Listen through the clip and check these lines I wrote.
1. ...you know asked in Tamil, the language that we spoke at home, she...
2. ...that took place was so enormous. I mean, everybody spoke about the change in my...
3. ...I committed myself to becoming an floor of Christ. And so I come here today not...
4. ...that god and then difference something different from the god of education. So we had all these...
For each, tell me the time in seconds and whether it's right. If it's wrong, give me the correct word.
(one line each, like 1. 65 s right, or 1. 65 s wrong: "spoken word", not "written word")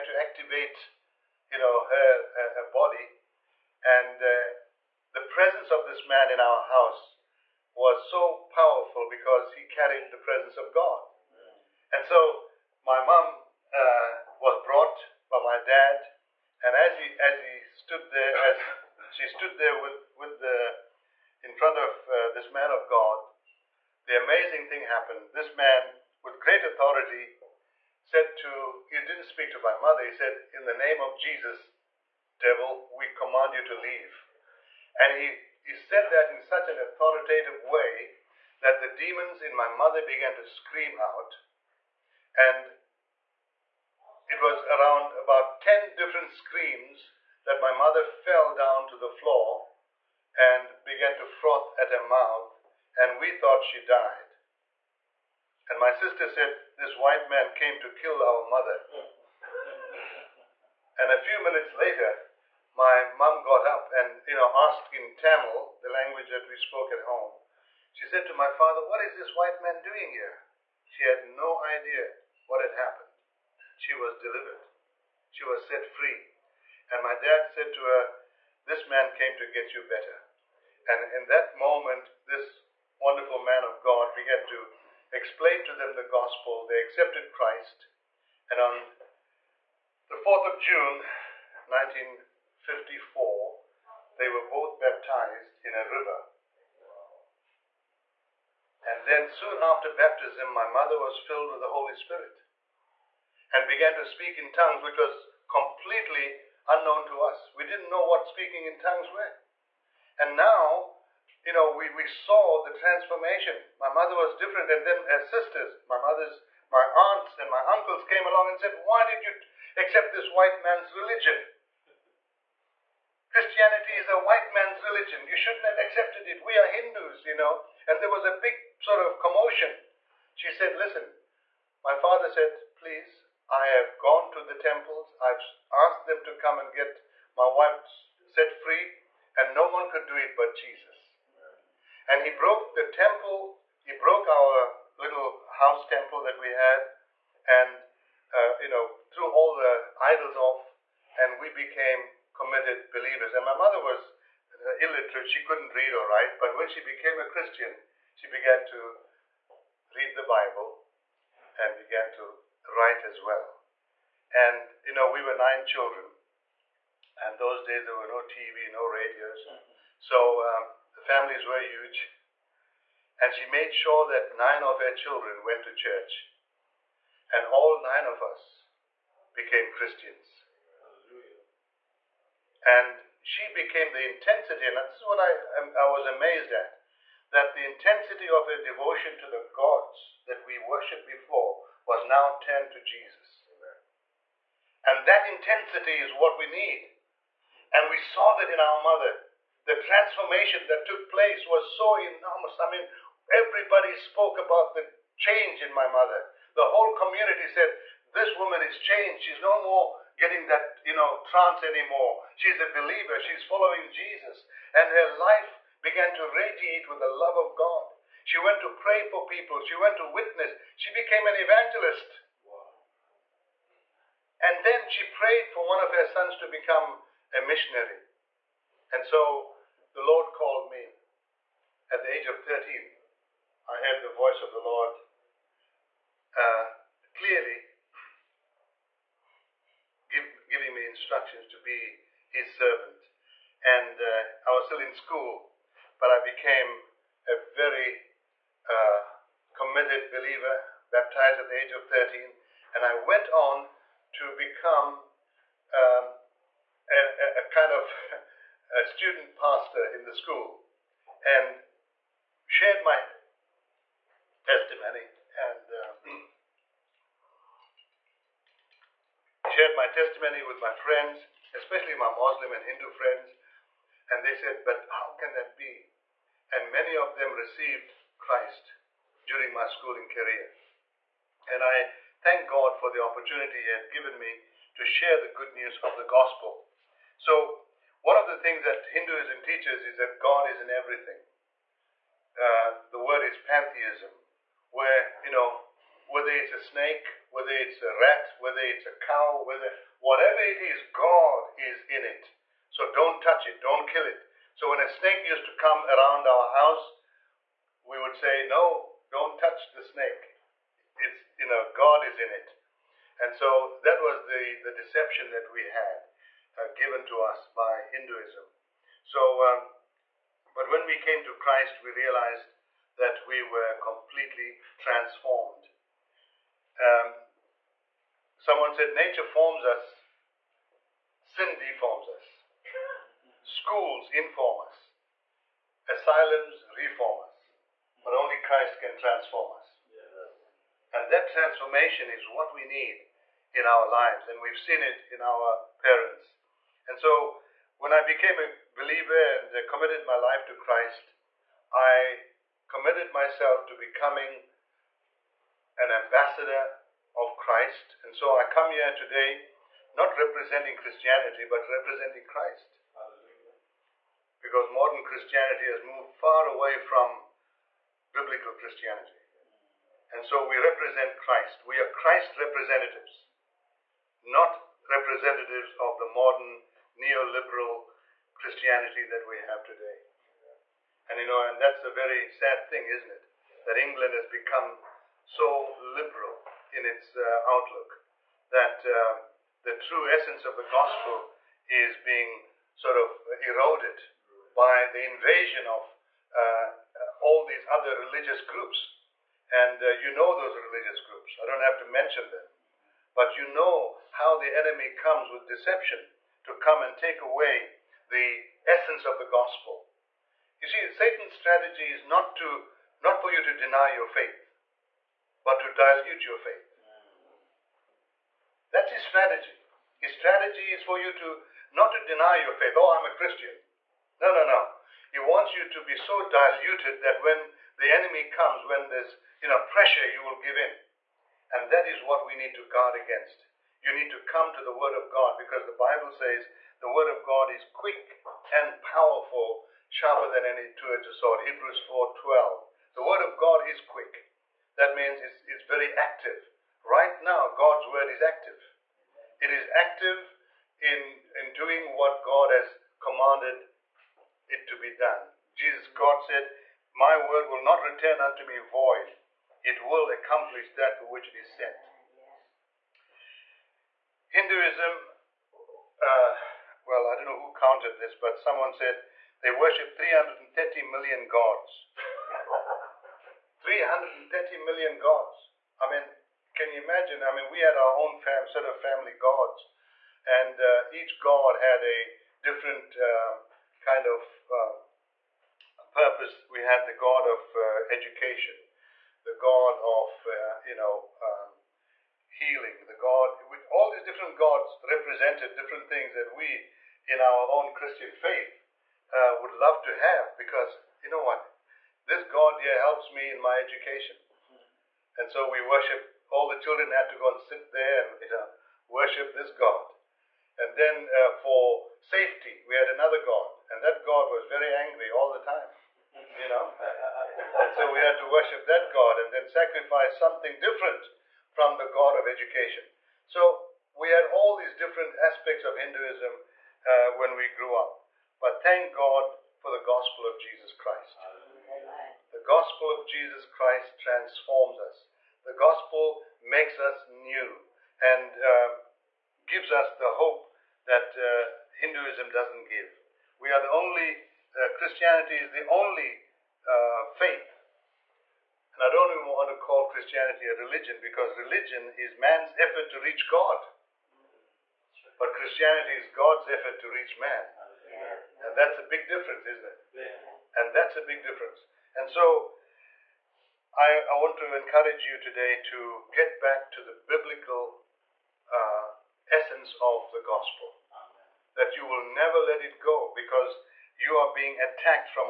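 1. 64 s right
2. 200 s right
3. 351 s wrong: "ambassador", not "floor"
4. 518 s wrong: "sacrifice", not "difference".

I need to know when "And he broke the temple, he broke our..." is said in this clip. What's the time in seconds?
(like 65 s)
142 s.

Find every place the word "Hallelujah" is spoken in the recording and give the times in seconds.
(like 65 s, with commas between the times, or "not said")
180 s, 362 s.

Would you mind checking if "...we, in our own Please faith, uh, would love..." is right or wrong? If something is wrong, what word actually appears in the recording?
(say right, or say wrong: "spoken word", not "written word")
wrong: "Christian", not "Please".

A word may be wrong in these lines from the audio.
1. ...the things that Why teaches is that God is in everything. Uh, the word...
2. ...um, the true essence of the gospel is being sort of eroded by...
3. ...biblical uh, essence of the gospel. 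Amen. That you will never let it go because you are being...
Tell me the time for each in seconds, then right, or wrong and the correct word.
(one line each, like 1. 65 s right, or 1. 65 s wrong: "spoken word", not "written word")
1. 288 s wrong: "Hinduism", not "Why"
2. 388 s right
3. 566 s right.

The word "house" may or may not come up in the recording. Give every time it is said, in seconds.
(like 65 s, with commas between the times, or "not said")
6 s, 145 s, 306 s.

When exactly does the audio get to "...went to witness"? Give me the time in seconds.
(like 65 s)
219 s.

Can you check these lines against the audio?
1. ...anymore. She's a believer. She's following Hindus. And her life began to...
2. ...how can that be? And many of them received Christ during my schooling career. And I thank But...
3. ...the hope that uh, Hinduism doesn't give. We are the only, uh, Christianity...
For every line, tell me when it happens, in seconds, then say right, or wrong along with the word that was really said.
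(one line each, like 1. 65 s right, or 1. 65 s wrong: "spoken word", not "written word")
1. 211 s wrong: "Jesus", not "Hindus"
2. 274 s wrong: "God", not "But"
3. 539 s right.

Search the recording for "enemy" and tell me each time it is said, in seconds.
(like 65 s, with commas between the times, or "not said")
404 s, 427 s.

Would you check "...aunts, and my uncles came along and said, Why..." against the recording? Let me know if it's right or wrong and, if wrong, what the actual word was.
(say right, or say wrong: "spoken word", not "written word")
right.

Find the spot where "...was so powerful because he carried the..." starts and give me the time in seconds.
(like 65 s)
7 s.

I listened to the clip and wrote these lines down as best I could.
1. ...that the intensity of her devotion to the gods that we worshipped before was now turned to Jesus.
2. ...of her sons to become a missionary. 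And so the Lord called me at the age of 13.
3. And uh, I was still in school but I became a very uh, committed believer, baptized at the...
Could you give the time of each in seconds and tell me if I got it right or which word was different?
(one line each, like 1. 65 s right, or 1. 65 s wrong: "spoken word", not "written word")
1. 187 s right
2. 225 s right
3. 243 s right.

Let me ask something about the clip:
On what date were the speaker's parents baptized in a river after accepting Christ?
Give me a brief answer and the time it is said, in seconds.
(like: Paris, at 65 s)
4 June 1954, at 90 s.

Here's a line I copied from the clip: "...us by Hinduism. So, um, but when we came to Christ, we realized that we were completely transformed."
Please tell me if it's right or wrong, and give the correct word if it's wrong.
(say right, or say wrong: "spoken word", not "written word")
right.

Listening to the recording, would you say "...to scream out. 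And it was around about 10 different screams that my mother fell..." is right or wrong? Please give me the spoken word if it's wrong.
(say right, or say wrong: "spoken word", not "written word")
right.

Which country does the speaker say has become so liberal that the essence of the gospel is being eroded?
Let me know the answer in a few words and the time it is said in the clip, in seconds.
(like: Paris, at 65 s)
England, at 383 s.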